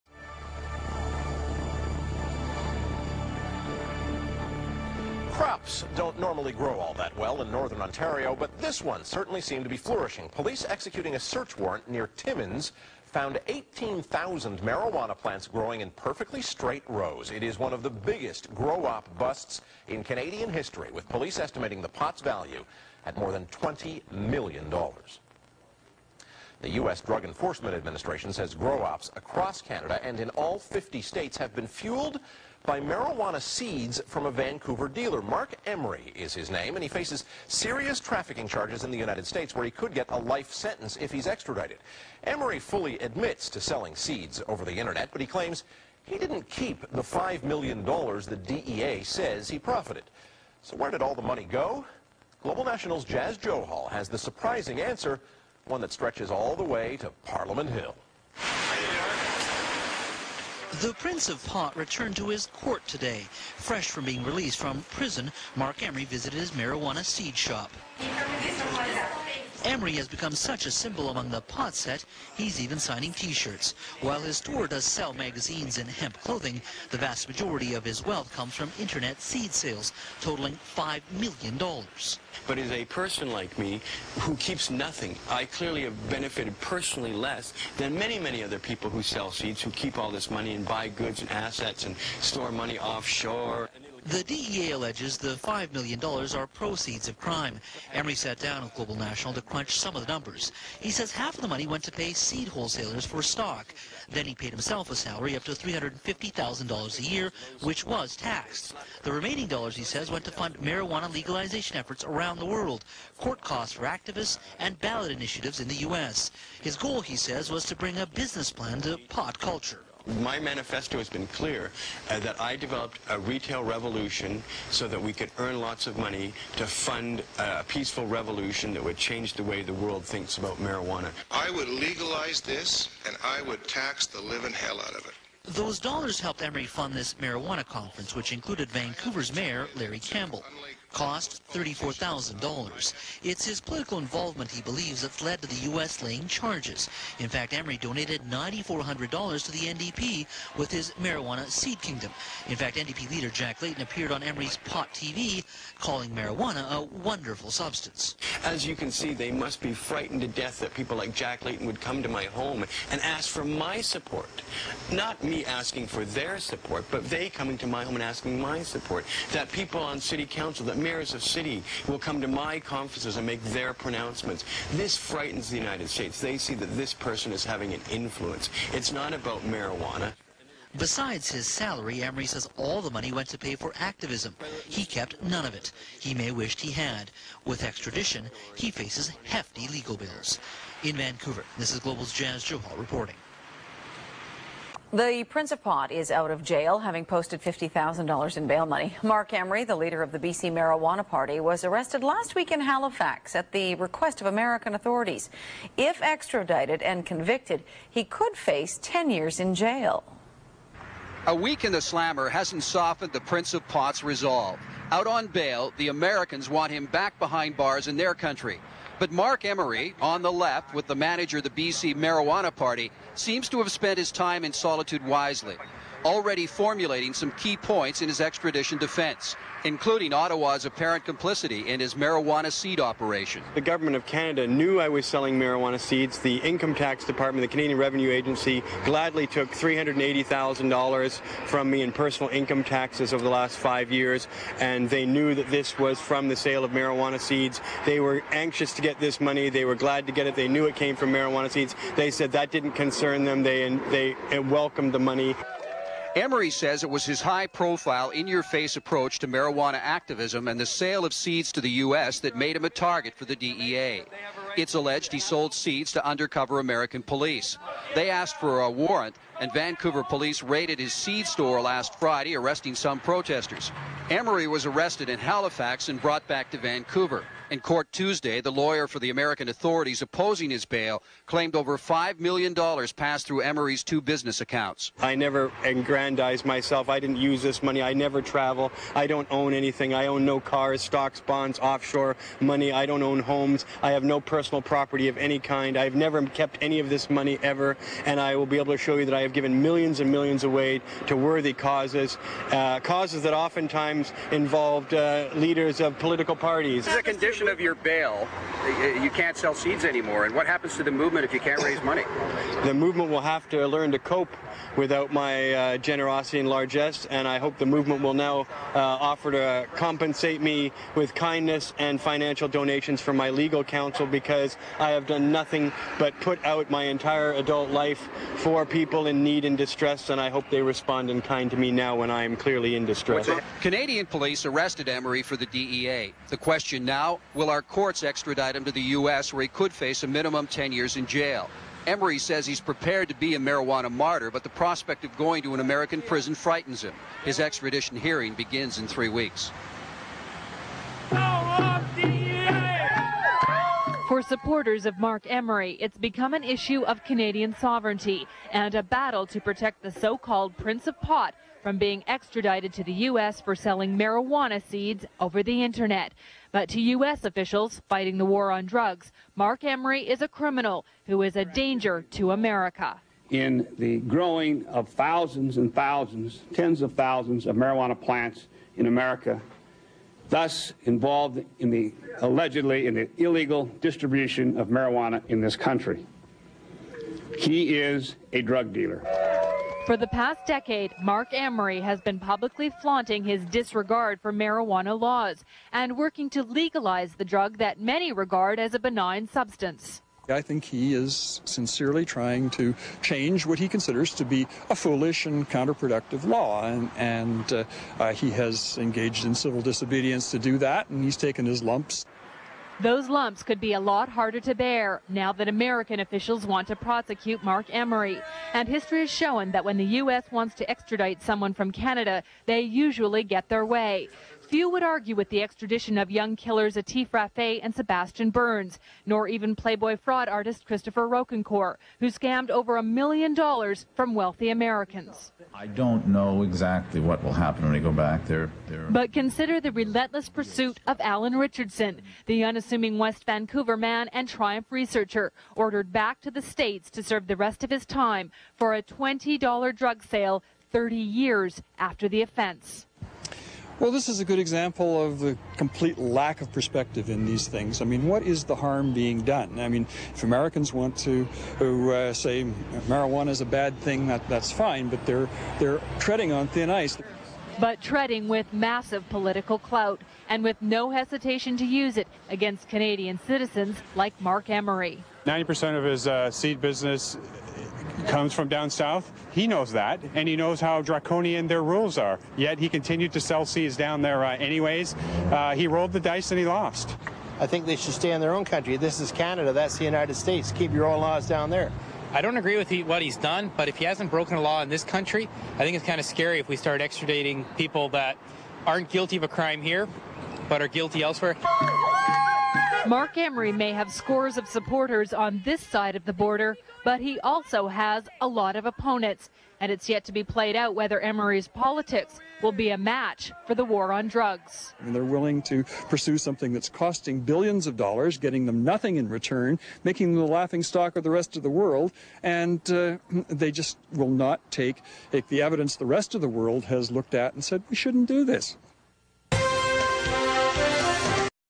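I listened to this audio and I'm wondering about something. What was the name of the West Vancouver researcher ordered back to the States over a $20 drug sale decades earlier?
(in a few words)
Alan Richardson.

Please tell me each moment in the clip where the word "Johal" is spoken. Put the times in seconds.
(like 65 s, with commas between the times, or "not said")
53 s, 192 s.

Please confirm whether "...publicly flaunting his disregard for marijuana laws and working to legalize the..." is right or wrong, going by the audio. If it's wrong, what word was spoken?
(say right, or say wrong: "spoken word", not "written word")
right.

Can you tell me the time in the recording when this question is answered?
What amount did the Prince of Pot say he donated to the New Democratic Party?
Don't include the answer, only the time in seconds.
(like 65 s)
148 s.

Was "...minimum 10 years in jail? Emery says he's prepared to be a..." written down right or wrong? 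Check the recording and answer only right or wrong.
right.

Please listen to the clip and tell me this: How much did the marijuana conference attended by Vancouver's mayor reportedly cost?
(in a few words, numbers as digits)
$34,000.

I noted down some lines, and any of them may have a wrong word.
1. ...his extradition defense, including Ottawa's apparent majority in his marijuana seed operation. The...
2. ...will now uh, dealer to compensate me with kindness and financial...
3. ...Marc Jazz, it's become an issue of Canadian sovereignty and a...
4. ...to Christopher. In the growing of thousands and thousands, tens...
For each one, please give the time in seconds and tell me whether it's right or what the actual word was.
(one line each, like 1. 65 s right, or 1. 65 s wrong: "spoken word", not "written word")
1. 228 s wrong: "complicity", not "majority"
2. 318 s wrong: "offer", not "dealer"
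3. 354 s wrong: "Emery", not "Jazz"
4. 372 s wrong: "America", not "Christopher".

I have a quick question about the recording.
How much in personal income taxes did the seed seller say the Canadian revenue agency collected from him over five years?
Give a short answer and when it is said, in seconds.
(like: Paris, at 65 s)
$380,000, at 239 s.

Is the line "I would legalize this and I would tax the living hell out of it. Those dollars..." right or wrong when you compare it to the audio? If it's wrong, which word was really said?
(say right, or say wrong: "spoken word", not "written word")
right.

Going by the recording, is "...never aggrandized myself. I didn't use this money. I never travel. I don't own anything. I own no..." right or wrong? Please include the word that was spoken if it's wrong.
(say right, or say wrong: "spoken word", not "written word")
right.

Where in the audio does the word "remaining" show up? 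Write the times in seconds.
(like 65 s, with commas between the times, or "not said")
109 s.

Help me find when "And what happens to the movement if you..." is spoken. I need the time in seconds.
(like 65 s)
310 s.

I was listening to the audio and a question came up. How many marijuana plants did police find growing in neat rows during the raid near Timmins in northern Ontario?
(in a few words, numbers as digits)
18,000.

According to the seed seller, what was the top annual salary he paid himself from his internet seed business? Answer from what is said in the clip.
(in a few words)
$350,000.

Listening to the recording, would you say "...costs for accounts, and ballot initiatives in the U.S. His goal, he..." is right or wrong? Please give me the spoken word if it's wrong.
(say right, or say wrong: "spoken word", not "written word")
wrong: "activists", not "accounts".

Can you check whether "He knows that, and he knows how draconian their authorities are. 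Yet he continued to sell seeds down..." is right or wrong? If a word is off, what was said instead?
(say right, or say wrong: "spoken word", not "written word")
wrong: "rules", not "authorities".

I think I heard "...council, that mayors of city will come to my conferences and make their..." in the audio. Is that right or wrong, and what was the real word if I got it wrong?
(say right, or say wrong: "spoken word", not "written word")
right.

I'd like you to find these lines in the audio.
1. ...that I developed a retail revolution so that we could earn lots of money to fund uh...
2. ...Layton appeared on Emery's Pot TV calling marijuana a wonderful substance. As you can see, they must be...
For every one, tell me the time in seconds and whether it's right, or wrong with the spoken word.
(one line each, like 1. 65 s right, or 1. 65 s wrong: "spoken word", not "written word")
1. 122 s right
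2. 153 s right.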